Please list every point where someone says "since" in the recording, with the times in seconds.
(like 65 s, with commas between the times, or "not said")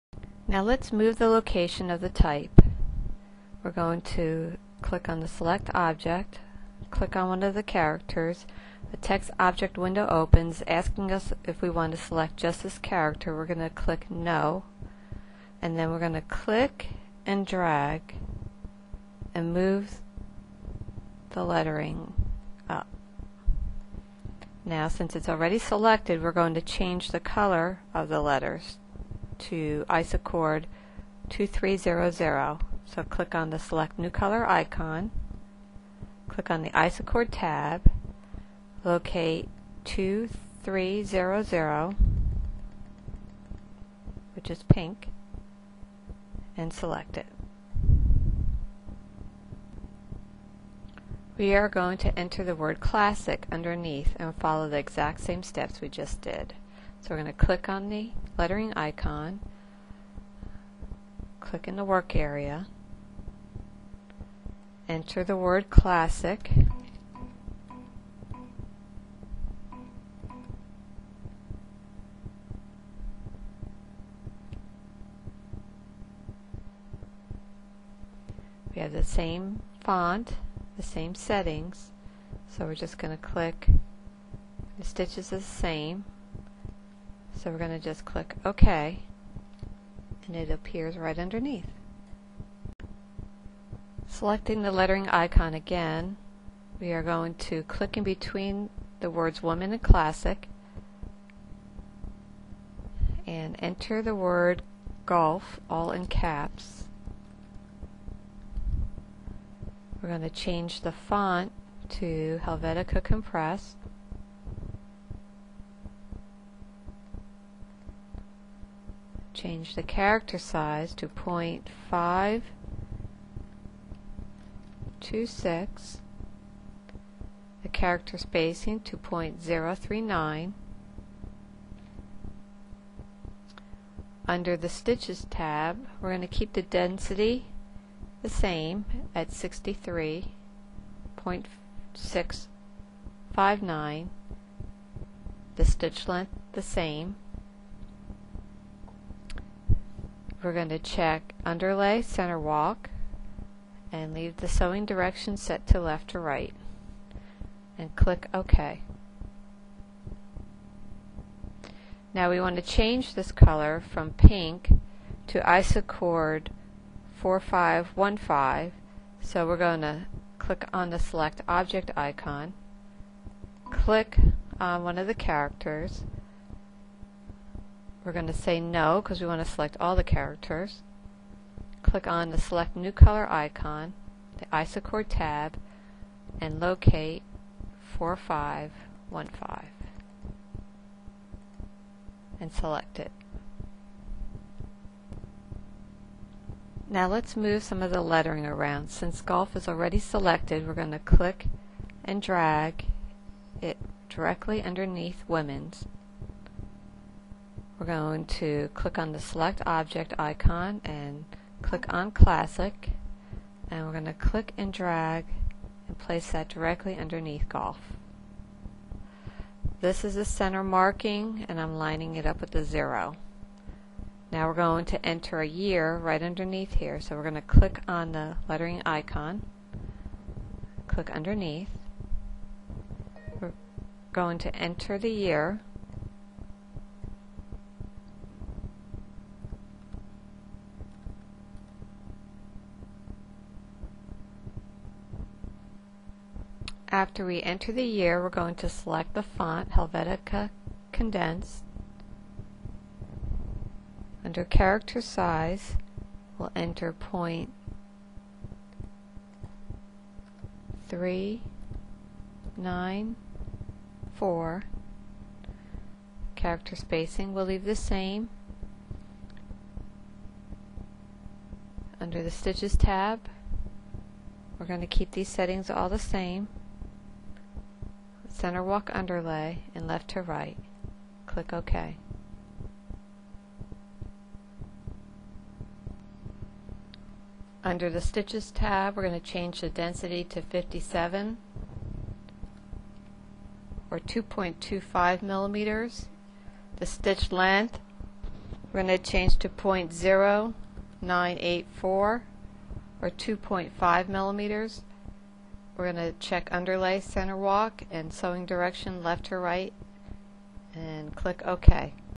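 24 s, 198 s.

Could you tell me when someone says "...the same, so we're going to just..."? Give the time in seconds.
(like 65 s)
85 s.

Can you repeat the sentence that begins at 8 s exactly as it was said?
The text object window opens asking us if we want to select just this character.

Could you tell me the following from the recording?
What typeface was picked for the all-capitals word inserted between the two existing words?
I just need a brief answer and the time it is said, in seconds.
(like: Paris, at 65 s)
Helvetica Compressed, at 112 s.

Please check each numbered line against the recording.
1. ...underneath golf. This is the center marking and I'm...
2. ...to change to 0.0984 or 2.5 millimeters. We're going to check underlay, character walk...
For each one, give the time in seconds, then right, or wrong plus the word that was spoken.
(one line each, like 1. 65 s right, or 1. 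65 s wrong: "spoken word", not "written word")
1. 216 s right
2. 298 s wrong: "center", not "character".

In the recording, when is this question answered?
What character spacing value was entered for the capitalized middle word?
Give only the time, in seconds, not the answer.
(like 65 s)
128 s.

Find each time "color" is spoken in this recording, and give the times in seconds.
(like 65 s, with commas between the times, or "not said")
27 s, 34 s, 163 s, 182 s.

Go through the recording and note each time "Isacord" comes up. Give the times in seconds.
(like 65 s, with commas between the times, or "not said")
29 s, 36 s, 165 s, 184 s.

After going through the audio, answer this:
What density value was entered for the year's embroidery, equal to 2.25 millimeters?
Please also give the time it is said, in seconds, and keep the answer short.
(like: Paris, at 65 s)
57, at 290 s.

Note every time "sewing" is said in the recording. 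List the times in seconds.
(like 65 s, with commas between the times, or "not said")
154 s, 308 s.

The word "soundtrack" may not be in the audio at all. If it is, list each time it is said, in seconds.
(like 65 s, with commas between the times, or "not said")
not said.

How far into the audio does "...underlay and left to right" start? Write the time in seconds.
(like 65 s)
278 s.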